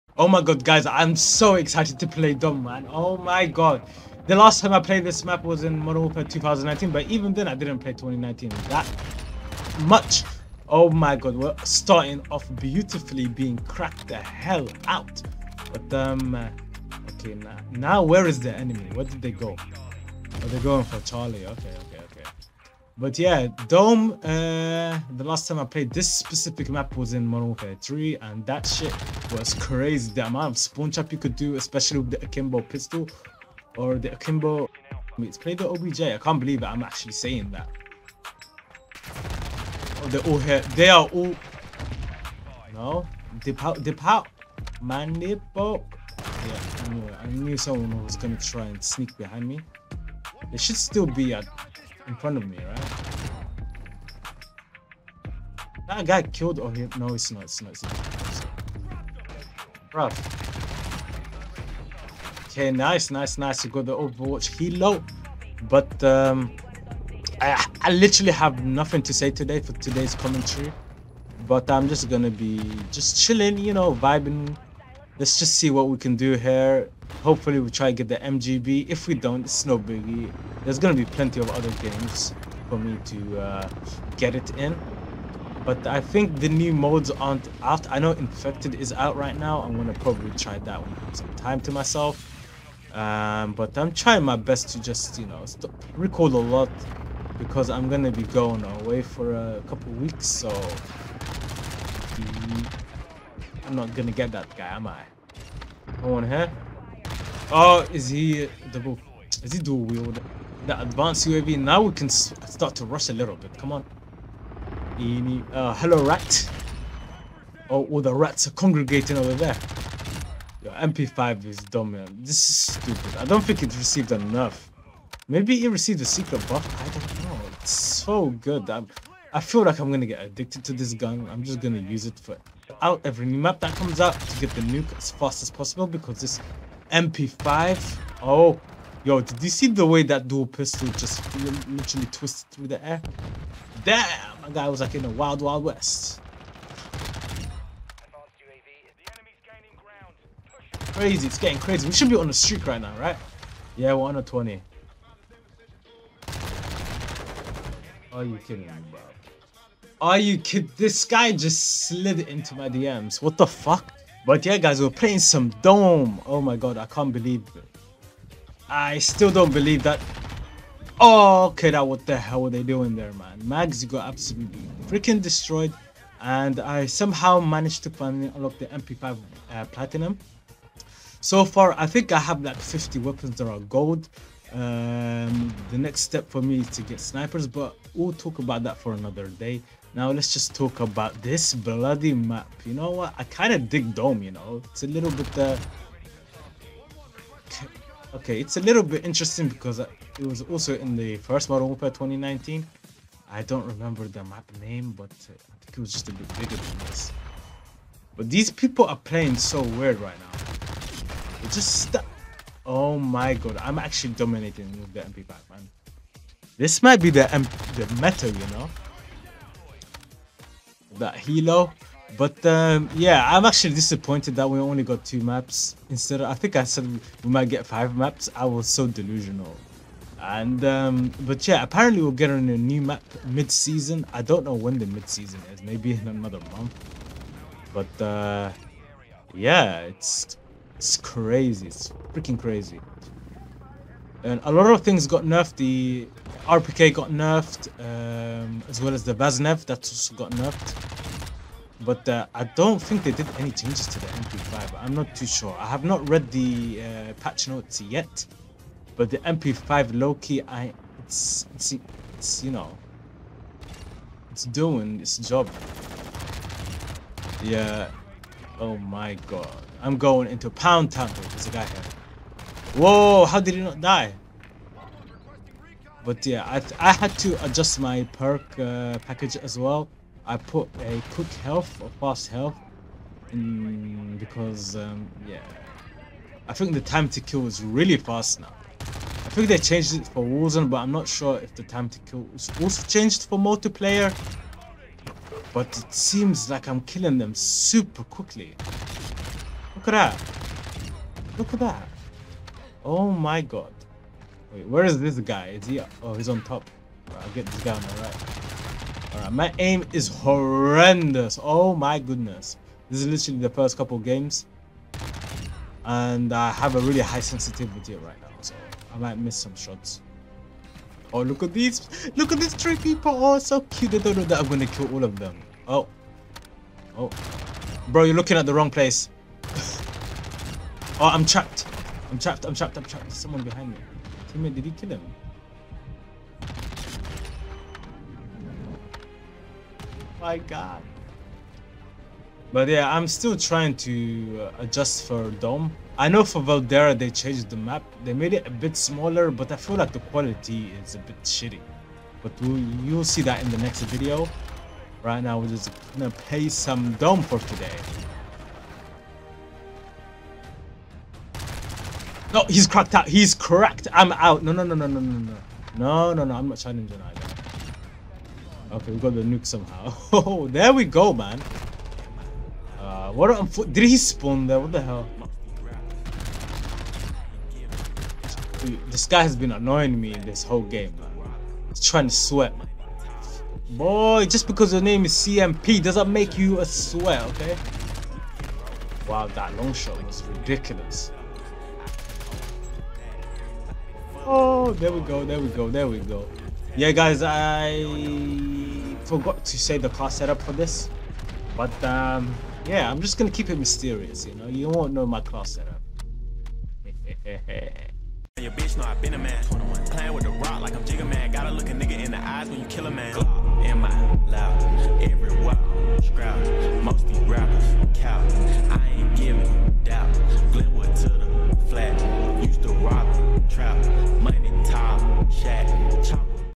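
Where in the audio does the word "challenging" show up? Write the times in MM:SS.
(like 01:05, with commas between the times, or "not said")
06:06.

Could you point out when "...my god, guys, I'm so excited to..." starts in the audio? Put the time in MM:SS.
00:00.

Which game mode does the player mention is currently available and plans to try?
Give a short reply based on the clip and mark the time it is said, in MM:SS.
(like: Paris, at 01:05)
Infected, at 01:28.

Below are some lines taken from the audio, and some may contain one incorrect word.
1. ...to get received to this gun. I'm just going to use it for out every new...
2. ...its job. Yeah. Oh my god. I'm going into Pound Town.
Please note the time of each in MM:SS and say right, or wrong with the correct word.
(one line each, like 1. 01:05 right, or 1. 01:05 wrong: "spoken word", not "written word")
1. 02:10 wrong: "addicted", not "received"
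2. 04:24 right.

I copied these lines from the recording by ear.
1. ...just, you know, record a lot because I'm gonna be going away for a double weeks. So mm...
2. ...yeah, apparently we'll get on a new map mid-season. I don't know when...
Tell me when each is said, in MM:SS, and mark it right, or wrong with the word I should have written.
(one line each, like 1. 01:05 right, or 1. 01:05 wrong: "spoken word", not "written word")
1. 01:34 wrong: "couple", not "double"
2. 03:51 right.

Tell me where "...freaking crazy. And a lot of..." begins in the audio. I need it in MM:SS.
04:02.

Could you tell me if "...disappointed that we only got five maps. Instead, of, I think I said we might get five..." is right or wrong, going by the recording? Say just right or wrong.
wrong.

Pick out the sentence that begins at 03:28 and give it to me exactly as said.
But these people are playing so weird right now.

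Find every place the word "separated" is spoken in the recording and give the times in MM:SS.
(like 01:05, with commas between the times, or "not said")
not said.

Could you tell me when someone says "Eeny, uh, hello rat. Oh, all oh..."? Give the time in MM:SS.
01:54.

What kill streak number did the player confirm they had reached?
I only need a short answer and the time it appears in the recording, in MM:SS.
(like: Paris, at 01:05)
20, at 02:34.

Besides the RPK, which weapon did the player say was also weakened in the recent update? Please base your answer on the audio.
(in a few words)
Baznev.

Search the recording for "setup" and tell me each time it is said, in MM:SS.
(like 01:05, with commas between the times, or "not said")
06:40, 06:45.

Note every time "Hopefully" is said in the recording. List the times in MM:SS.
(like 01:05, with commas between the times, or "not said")
01:17.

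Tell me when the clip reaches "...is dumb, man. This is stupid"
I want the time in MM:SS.
02:01.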